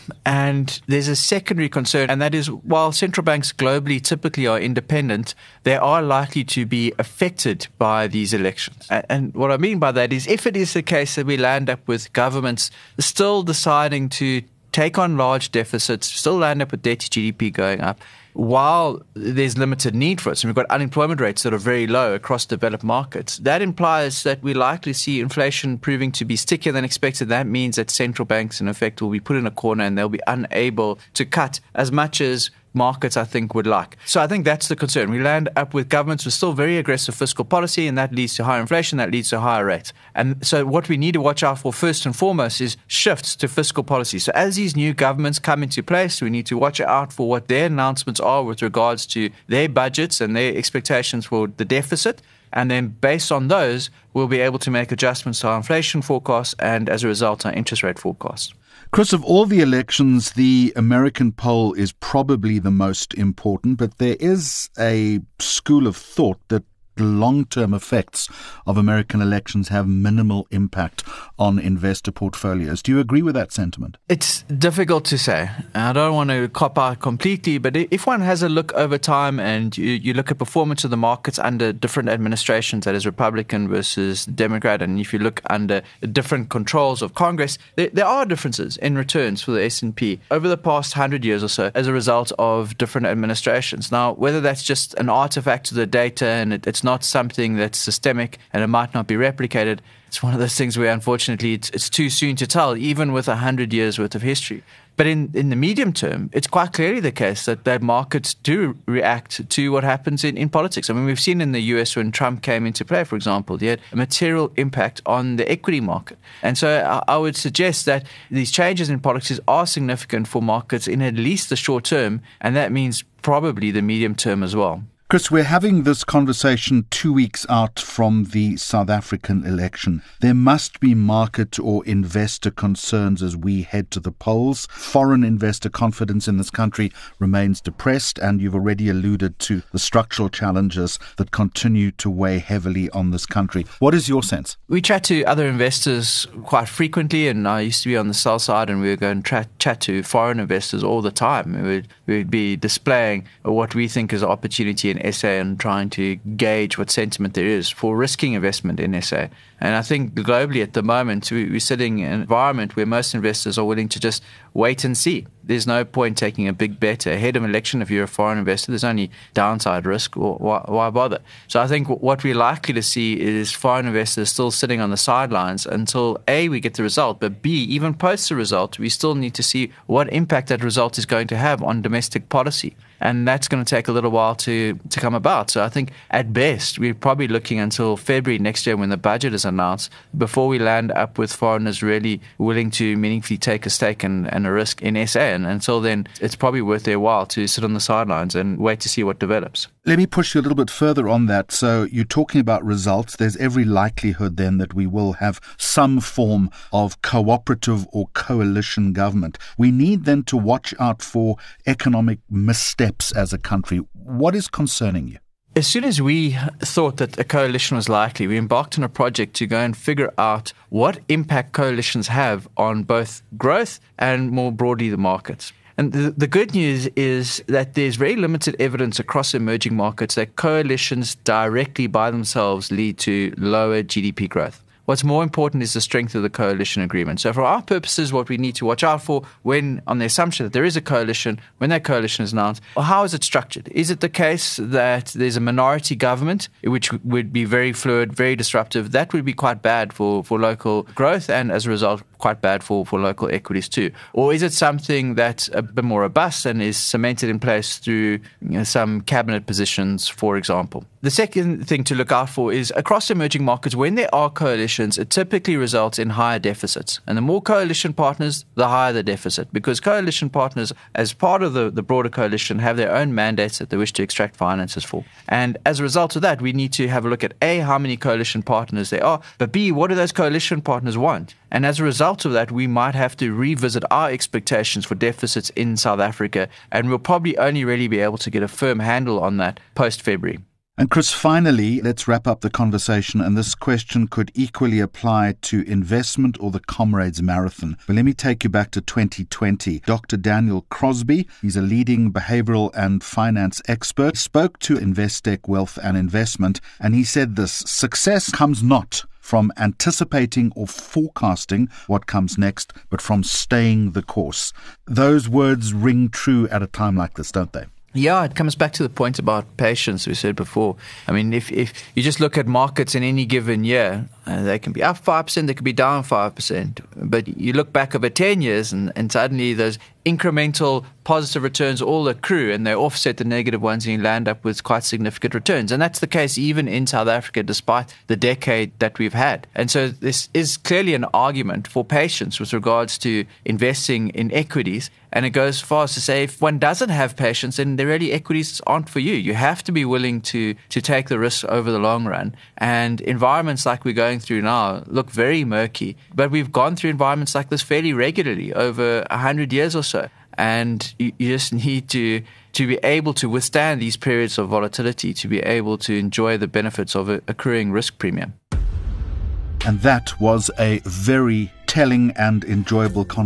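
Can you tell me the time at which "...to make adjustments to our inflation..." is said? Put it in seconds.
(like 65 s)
54 s.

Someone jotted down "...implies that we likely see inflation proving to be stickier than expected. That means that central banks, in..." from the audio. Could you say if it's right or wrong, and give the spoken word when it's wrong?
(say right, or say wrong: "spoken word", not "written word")
right.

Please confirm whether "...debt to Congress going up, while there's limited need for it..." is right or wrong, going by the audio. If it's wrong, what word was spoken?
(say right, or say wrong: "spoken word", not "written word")
wrong: "GDP", not "Congress".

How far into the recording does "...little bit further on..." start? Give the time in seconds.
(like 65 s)
200 s.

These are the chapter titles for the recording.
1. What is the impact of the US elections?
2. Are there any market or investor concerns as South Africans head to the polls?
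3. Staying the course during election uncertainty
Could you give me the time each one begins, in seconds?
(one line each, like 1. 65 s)
1. 57 s
2. 123 s
3. 288 s.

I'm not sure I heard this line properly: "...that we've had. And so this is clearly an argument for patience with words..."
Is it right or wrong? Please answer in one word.
wrong.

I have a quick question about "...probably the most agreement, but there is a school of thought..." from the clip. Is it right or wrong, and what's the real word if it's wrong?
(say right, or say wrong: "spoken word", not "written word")
wrong: "important", not "agreement".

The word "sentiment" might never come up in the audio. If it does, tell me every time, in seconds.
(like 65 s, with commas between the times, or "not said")
73 s, 156 s.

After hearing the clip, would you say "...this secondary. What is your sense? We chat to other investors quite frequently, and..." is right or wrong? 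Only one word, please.
wrong.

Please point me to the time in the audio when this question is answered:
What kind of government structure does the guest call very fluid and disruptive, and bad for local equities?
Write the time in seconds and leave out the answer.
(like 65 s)
245 s.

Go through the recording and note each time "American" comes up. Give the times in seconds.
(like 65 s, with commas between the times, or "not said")
60 s, 68 s.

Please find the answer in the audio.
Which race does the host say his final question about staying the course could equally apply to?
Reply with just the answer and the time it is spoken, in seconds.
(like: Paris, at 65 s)
Comrades Marathon, at 296 s.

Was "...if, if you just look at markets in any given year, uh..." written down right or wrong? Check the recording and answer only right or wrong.
right.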